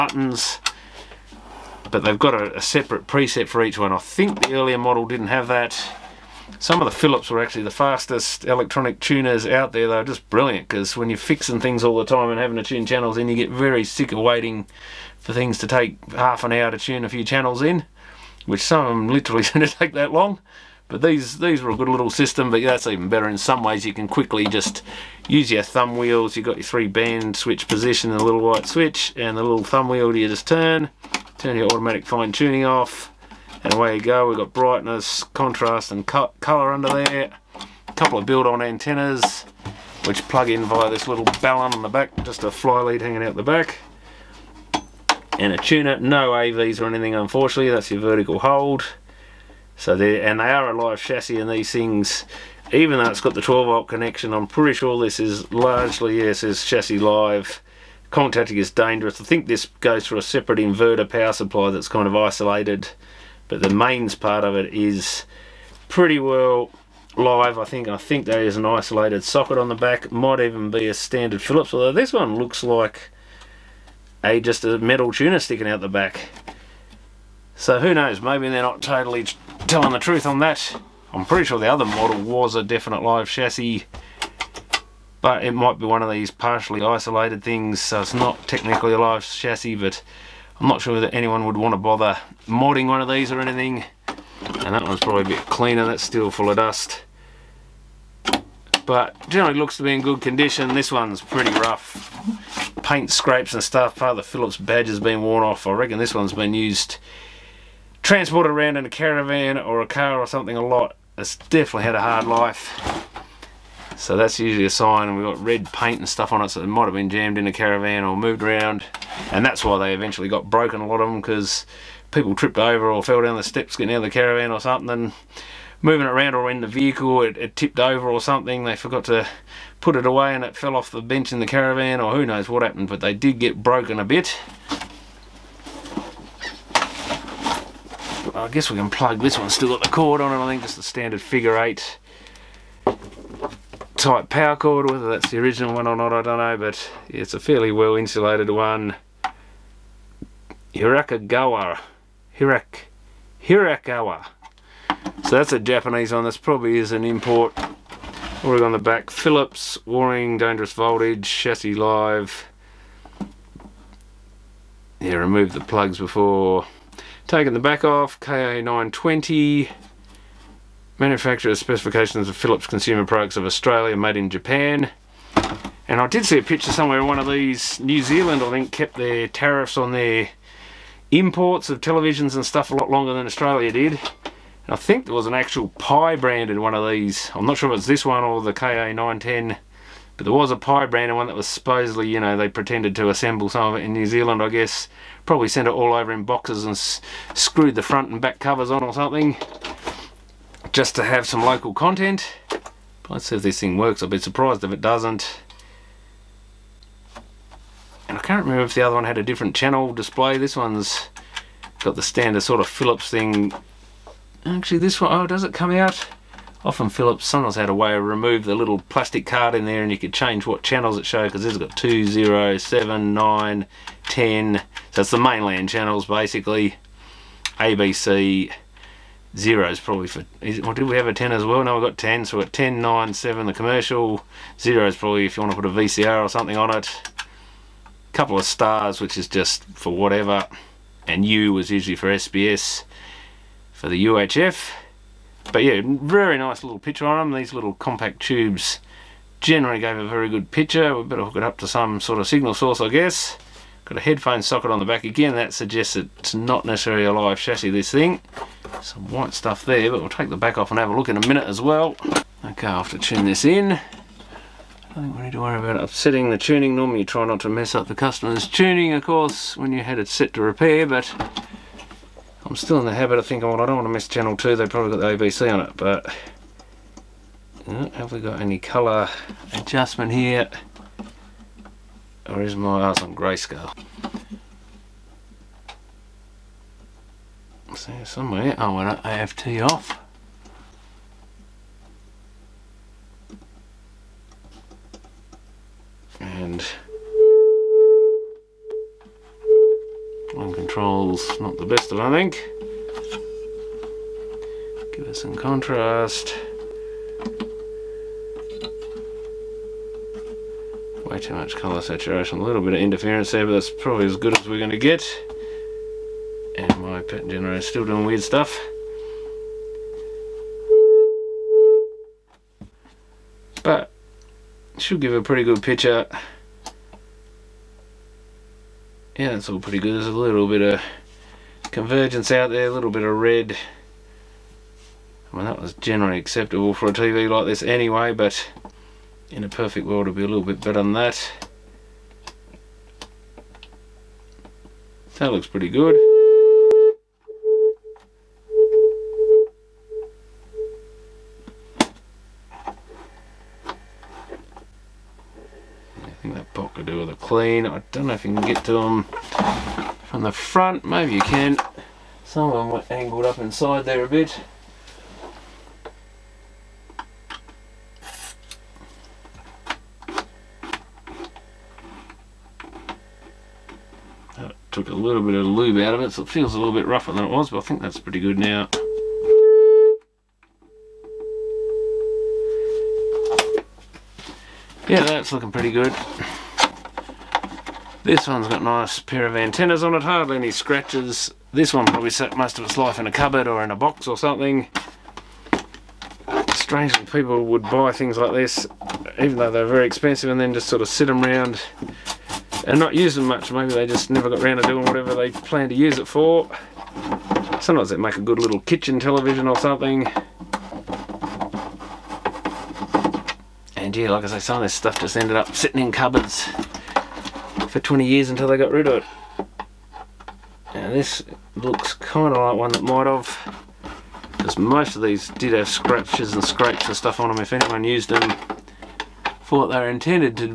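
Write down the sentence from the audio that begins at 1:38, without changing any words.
But generally looks to be in good condition.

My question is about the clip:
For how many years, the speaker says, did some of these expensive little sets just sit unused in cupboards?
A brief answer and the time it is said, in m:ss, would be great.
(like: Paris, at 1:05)
20, at 6:57.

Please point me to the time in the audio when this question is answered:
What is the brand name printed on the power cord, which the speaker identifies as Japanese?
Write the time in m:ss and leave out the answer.
2:33.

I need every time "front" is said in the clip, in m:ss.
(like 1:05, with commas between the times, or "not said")
3:17, 6:00.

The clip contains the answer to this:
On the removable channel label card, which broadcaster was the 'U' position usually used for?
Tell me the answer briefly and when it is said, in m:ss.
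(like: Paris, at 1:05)
SBS, at 4:02.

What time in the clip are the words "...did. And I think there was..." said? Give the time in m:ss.
3:03.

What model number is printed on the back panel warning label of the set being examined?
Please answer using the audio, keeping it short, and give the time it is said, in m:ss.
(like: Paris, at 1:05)
KA920, at 2:48.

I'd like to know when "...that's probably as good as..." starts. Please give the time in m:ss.
5:13.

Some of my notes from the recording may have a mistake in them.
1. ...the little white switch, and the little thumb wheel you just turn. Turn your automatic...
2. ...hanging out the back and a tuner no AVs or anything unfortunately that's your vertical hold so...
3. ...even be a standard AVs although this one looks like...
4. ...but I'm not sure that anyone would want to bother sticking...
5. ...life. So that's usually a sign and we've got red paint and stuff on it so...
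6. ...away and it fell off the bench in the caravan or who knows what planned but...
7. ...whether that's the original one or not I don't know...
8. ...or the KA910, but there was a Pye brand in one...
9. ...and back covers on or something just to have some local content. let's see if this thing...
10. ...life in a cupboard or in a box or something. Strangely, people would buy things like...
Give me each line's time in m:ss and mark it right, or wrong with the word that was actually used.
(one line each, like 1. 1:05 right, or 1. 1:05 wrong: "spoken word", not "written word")
1. 0:28 right
2. 0:43 right
3. 1:10 wrong: "Phillips", not "AVs"
4. 1:29 wrong: "modding", not "sticking"
5. 1:52 right
6. 2:10 wrong: "happened", not "planned"
7. 2:24 right
8. 3:08 right
9. 3:18 right
10. 6:32 right.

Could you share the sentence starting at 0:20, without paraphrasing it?
But these, these were a good little system, but that's even better.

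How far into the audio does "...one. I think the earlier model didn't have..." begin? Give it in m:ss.
0:03.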